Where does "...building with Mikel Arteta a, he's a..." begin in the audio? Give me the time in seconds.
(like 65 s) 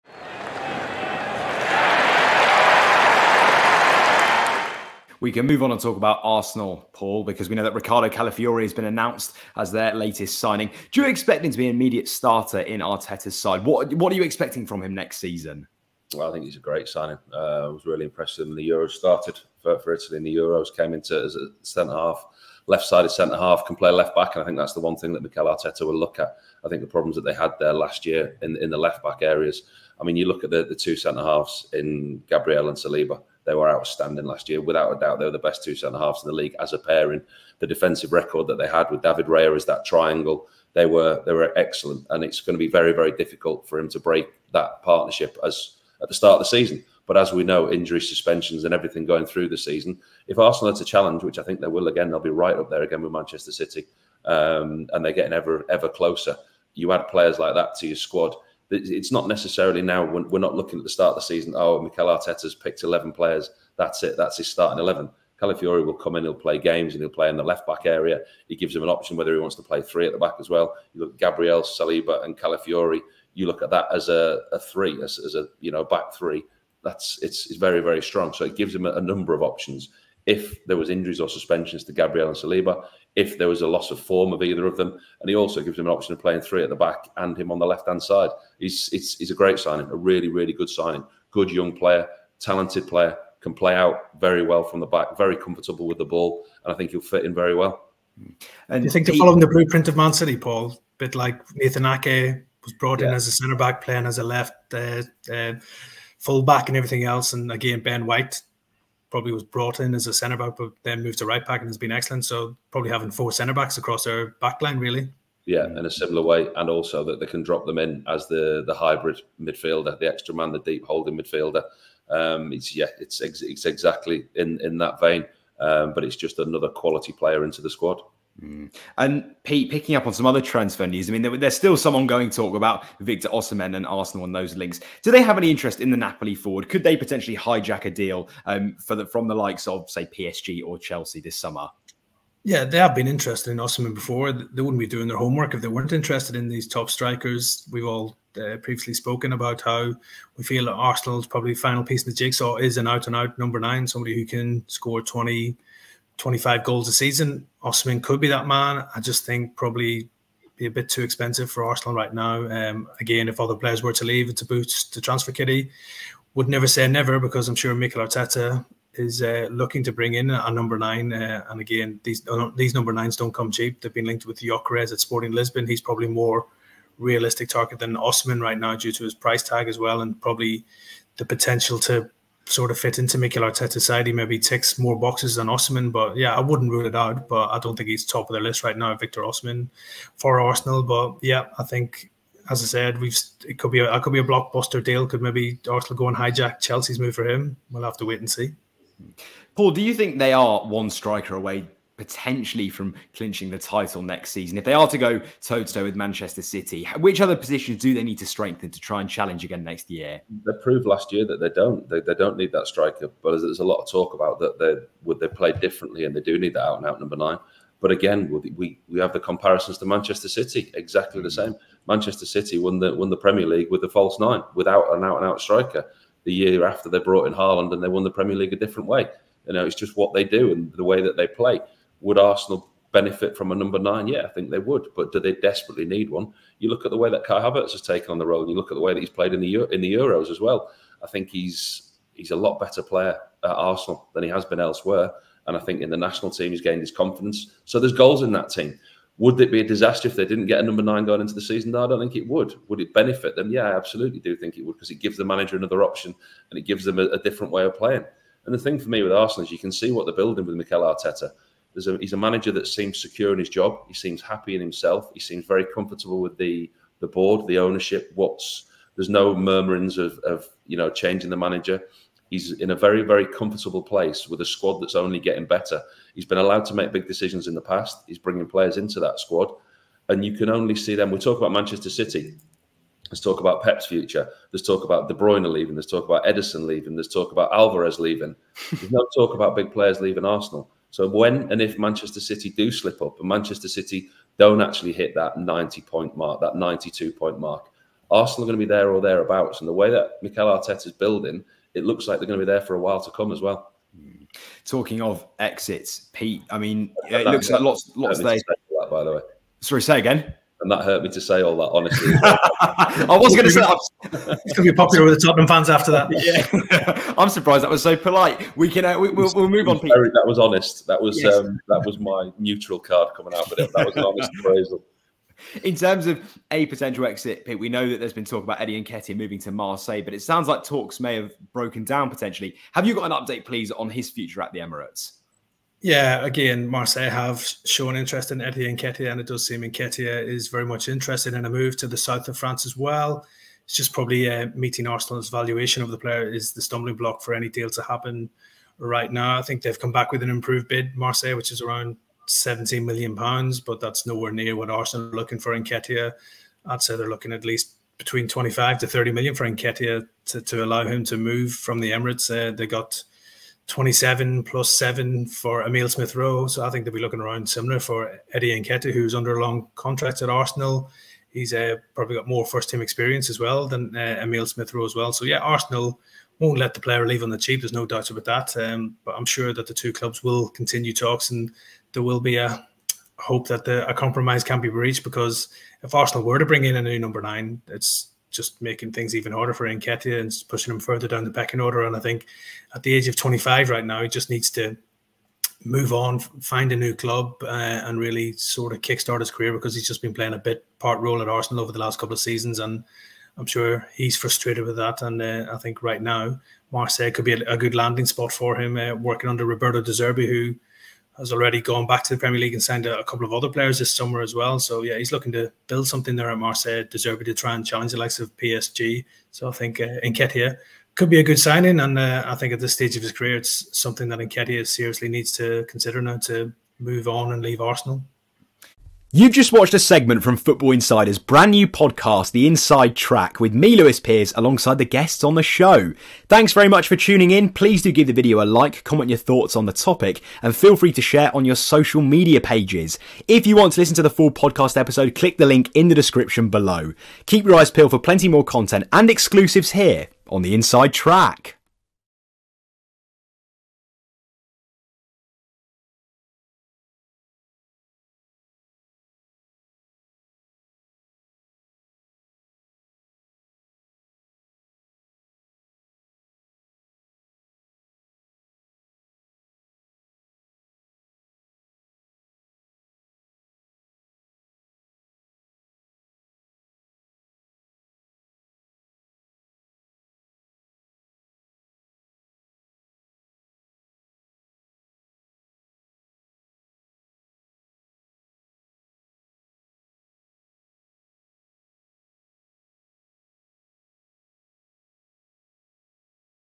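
260 s.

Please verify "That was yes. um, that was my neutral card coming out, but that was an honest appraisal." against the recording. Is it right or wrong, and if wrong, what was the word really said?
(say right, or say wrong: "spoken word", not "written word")
right.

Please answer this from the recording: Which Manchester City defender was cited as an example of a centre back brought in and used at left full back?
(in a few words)
Nathan Ake.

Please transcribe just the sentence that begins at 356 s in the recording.
I'd say they're looking at least between 25 to 30 million for Nketiah to, to allow him to move from the Emirates.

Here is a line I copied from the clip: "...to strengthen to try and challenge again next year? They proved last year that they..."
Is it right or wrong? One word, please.
right.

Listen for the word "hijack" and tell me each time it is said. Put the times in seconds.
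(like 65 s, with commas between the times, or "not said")
137 s, 196 s.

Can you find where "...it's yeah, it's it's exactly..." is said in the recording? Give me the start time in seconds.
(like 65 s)
122 s.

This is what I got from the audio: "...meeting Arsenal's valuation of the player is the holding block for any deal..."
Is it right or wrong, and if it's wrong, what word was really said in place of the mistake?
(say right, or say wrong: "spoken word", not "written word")
wrong: "stumbling", not "holding".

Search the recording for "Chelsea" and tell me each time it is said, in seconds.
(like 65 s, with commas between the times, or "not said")
140 s, 196 s.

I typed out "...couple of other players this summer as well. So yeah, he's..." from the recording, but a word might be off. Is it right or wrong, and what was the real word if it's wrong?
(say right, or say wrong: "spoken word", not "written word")
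right.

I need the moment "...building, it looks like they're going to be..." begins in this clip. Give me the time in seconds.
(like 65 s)
300 s.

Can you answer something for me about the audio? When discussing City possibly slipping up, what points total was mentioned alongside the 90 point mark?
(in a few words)
92.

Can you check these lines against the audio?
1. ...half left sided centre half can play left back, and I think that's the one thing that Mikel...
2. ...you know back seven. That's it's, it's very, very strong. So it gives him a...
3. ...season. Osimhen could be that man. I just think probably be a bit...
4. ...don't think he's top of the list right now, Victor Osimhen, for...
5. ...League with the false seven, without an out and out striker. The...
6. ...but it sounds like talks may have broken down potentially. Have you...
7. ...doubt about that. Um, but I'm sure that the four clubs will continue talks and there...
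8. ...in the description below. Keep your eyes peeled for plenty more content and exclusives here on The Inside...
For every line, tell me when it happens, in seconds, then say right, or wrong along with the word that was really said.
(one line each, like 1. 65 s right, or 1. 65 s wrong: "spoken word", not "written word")
1. 21 s right
2. 75 s wrong: "three", not "seven"
3. 156 s right
4. 187 s right
5. 223 s wrong: "nine", not "seven"
6. 330 s right
7. 377 s wrong: "two", not "four"
8. 445 s right.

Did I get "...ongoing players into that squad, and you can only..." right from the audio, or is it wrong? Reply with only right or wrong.
wrong.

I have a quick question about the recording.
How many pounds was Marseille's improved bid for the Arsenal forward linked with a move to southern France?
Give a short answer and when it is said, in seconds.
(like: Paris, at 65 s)
17 million pounds, at 352 s.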